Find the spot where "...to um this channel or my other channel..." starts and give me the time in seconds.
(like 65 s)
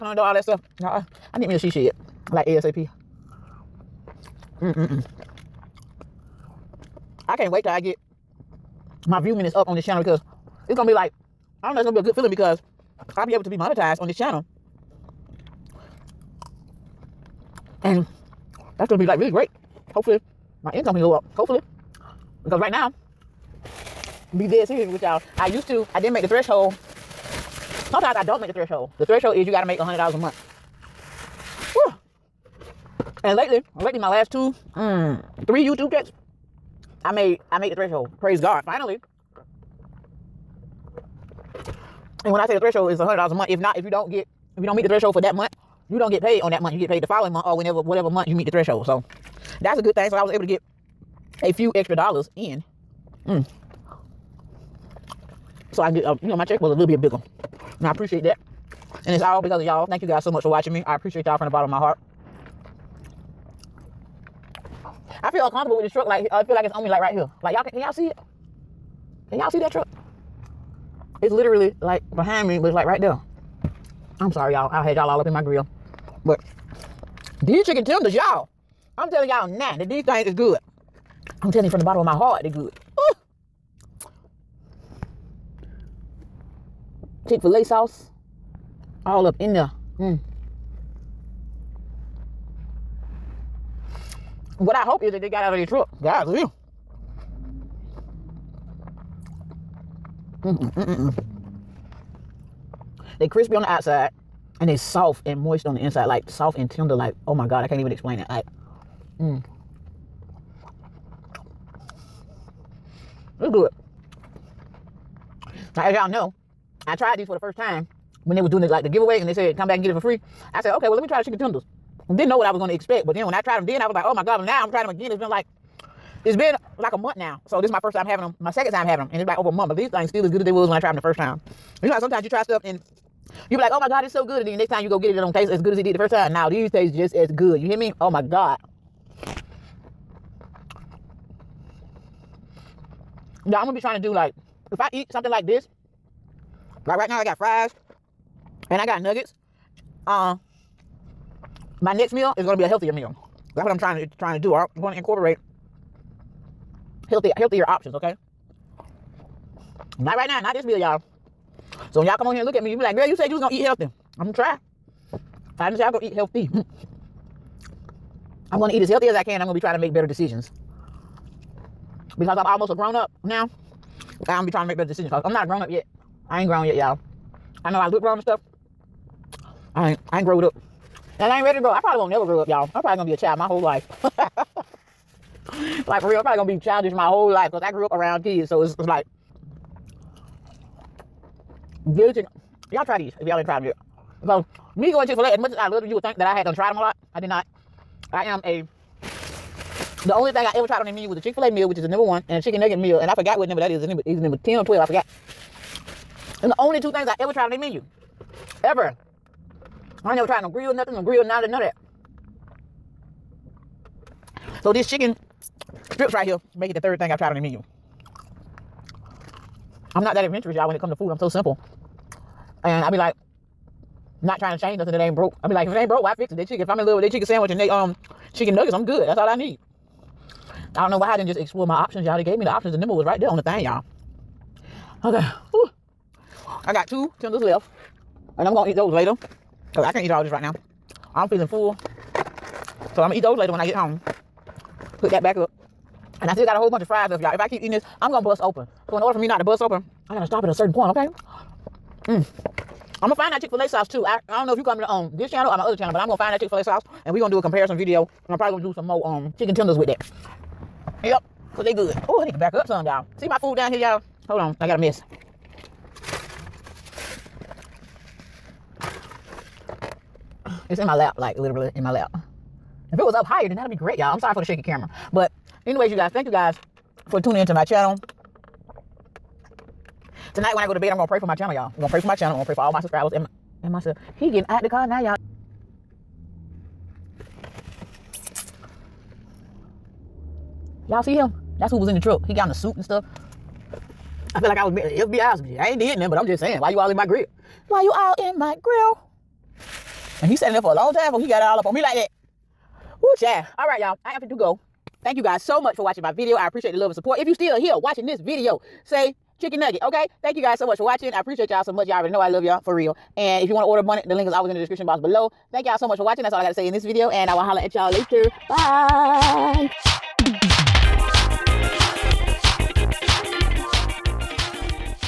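254 s.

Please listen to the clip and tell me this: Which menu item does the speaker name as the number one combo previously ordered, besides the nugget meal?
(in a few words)
Chick Fil A meal.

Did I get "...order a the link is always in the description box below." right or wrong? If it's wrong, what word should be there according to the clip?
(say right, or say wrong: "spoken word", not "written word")
right.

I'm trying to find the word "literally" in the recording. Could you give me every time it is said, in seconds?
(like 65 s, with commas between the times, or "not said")
71 s, 271 s.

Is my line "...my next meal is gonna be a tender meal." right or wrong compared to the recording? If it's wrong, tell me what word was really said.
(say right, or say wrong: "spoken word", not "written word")
wrong: "healthier", not "tender".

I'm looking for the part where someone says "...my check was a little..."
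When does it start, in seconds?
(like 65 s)
56 s.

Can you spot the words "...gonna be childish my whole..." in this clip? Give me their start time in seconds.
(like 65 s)
186 s.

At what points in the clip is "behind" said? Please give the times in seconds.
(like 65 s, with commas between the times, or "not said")
72 s.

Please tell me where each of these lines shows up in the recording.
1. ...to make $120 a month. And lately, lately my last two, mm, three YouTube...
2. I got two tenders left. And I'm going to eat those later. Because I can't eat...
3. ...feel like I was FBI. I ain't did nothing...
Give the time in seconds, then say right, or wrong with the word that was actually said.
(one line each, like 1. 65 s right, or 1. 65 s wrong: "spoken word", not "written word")
1. 29 s wrong: "100", not "120"
2. 236 s right
3. 294 s right.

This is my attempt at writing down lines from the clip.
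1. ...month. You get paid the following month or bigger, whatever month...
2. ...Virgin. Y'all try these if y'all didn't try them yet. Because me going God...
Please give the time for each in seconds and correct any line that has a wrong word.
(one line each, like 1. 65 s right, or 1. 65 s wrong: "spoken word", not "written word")
1. 46 s wrong: "whenever", not "bigger"
2. 191 s wrong: "Chick", not "God".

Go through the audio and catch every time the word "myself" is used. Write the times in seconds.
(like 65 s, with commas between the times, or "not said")
283 s.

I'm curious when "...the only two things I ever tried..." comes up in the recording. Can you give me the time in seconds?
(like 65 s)
206 s.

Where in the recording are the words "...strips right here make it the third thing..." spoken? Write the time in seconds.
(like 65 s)
215 s.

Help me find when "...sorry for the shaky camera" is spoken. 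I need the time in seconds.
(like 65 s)
274 s.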